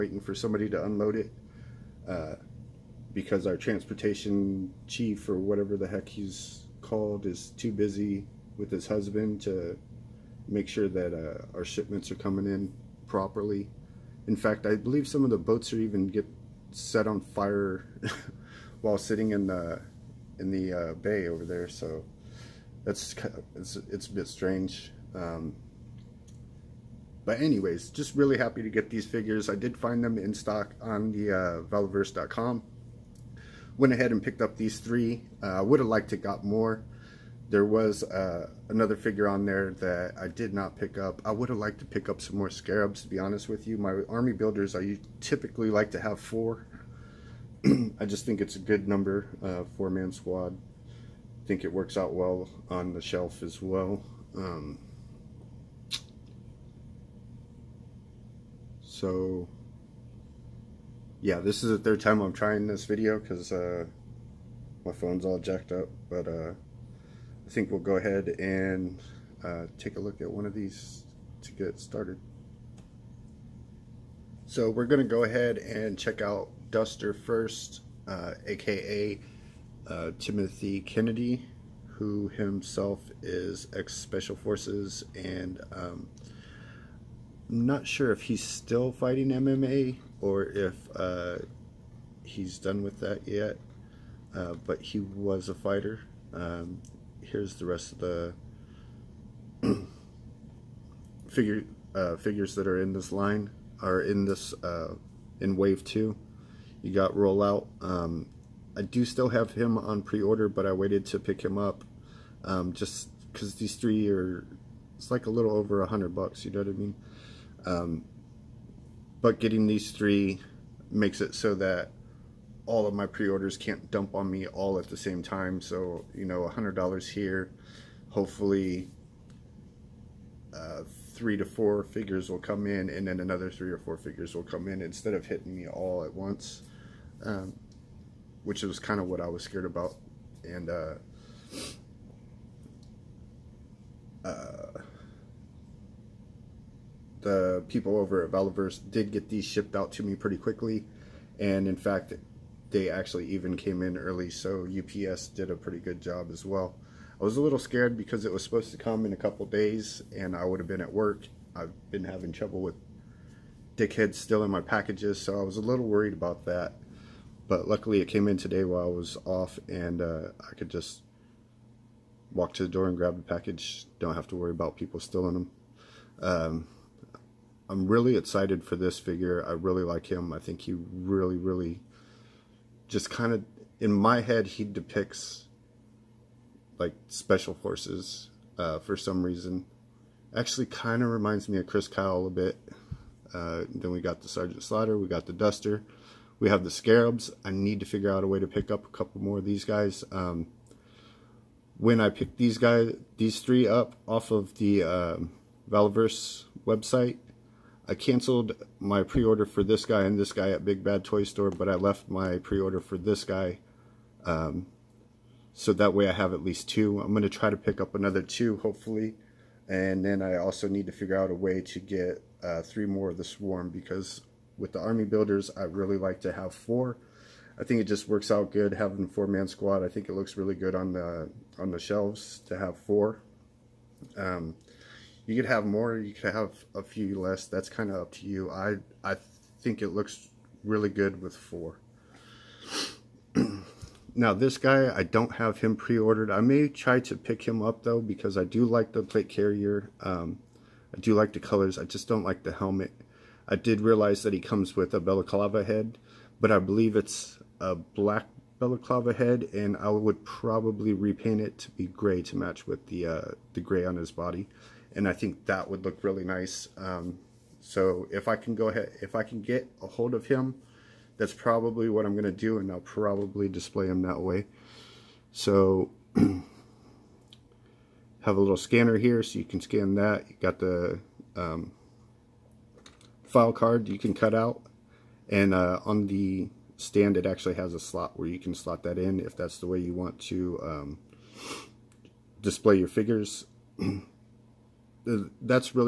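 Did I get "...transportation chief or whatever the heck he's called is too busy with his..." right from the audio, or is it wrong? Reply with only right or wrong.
right.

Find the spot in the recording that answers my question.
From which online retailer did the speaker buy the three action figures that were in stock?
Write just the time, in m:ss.
0:31.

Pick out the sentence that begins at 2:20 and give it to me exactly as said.
And uh, uh, the people over at Valaverse did get these shipped out to me pretty quickly.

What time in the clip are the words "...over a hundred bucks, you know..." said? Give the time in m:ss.
1:55.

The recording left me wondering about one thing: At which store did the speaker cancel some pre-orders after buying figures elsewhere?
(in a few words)
Big Bad Toy Store.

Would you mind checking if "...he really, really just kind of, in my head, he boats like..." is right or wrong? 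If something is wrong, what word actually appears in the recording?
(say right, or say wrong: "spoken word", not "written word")
wrong: "depicts", not "boats".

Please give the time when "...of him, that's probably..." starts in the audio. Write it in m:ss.
4:30.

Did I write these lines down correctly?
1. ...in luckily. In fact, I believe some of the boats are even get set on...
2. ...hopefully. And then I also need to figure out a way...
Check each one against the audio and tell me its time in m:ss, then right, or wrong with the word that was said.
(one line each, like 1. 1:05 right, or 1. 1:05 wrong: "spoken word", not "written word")
1. 0:12 wrong: "properly", not "luckily"
2. 3:38 right.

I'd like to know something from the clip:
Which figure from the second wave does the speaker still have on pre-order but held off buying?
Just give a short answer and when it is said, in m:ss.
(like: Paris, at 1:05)
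Rollout, at 1:47.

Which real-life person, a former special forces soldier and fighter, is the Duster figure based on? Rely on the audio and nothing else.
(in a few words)
Timothy Kennedy.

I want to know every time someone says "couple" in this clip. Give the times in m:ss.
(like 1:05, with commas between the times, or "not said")
2:39, 3:18.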